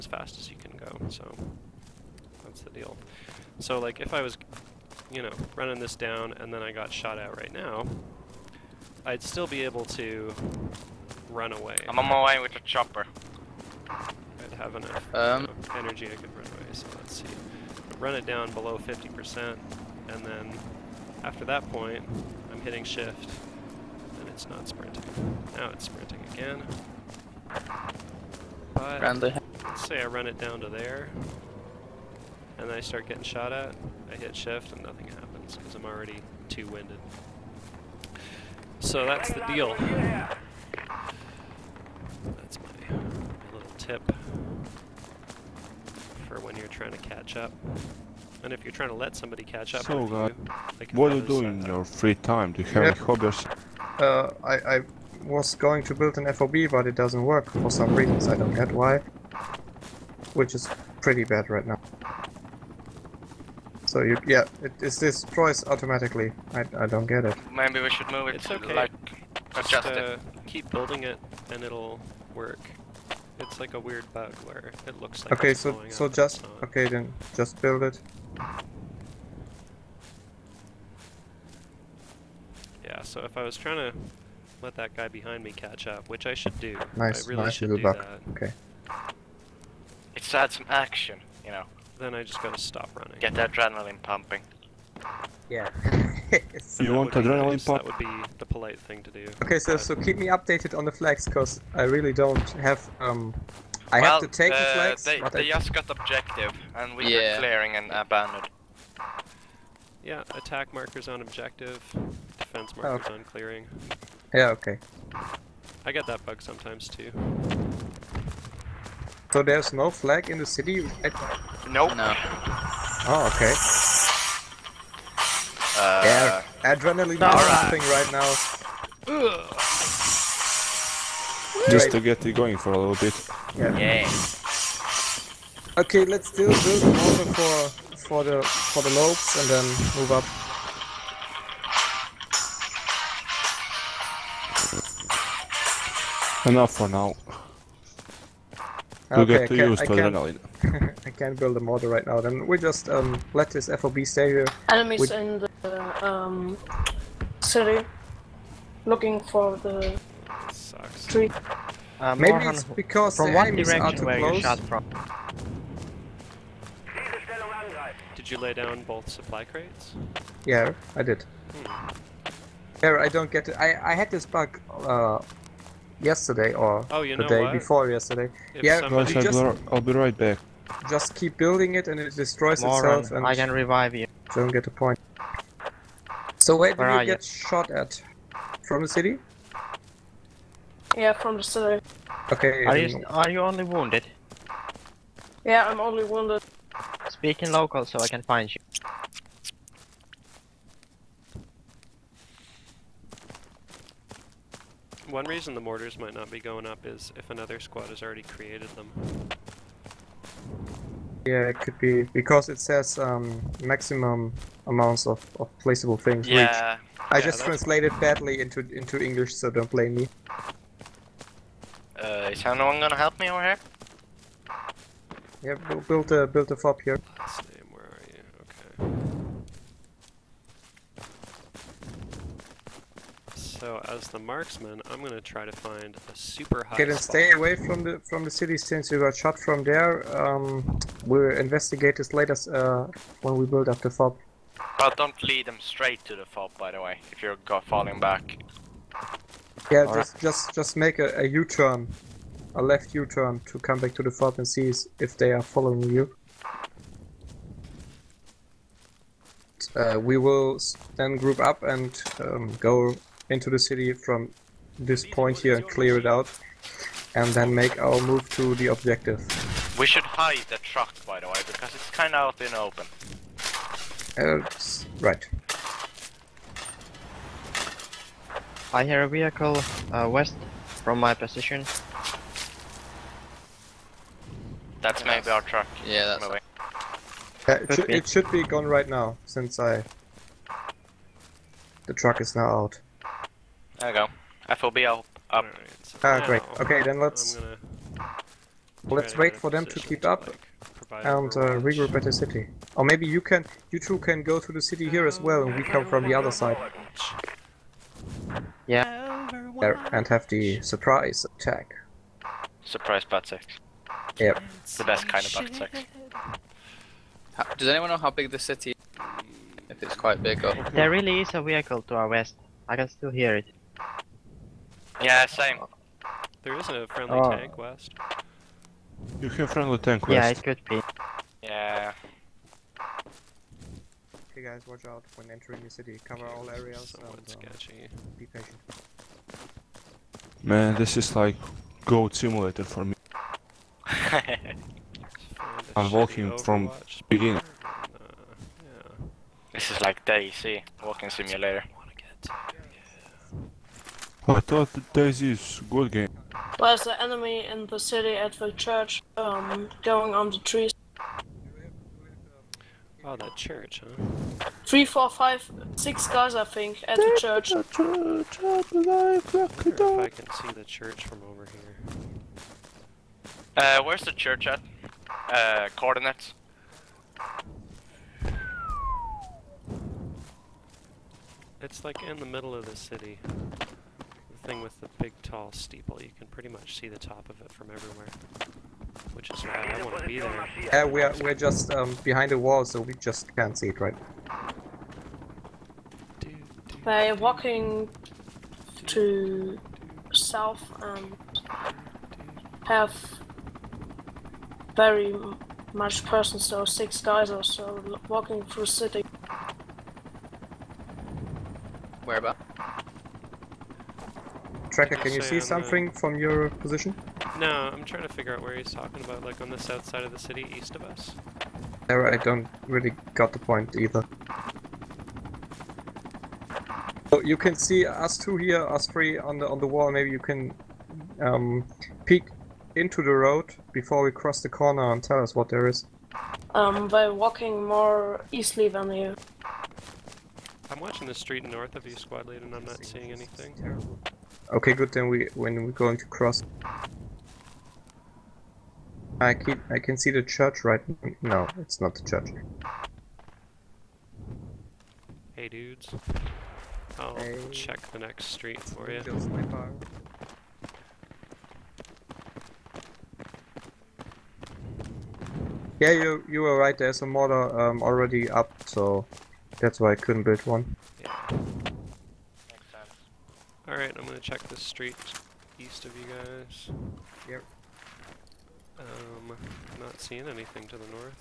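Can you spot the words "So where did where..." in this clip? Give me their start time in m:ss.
3:06.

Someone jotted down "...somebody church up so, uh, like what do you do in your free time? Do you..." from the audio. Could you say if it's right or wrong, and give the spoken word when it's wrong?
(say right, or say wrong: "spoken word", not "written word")
wrong: "catch", not "church".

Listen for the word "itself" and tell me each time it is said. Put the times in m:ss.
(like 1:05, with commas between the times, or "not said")
3:02.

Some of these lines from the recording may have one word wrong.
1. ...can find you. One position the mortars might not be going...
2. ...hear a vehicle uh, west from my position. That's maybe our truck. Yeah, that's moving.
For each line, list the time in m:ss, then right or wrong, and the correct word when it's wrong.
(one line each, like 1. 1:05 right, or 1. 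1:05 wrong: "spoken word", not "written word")
1. 3:18 wrong: "reason", not "position"
2. 4:38 right.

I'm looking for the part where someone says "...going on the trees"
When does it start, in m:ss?
5:59.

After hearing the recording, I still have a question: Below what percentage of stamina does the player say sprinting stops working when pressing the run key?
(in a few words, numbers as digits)
50%.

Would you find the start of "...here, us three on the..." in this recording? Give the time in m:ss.
7:08.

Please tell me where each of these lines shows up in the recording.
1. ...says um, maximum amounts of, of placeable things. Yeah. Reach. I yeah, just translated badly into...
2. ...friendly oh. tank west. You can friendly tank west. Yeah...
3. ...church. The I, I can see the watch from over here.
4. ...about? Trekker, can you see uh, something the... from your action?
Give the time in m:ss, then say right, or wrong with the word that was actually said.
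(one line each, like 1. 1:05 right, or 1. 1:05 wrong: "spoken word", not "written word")
1. 3:32 right
2. 5:26 right
3. 6:07 wrong: "church", not "watch"
4. 6:52 wrong: "position", not "action".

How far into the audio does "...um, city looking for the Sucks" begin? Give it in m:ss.
2:36.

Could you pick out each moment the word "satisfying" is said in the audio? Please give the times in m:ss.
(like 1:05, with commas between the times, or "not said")
not said.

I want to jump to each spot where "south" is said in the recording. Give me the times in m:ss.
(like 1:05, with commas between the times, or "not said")
6:40, 6:59.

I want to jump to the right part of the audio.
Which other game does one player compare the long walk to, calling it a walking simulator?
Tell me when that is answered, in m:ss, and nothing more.
5:50.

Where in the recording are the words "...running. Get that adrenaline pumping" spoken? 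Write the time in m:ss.
1:32.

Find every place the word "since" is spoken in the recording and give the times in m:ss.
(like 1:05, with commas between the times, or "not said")
3:58, 4:49.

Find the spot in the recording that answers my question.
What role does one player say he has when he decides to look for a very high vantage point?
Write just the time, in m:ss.
3:54.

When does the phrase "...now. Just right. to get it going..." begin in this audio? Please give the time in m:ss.
2:08.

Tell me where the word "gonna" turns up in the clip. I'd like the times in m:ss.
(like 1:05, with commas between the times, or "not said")
3:42, 3:55, 7:54.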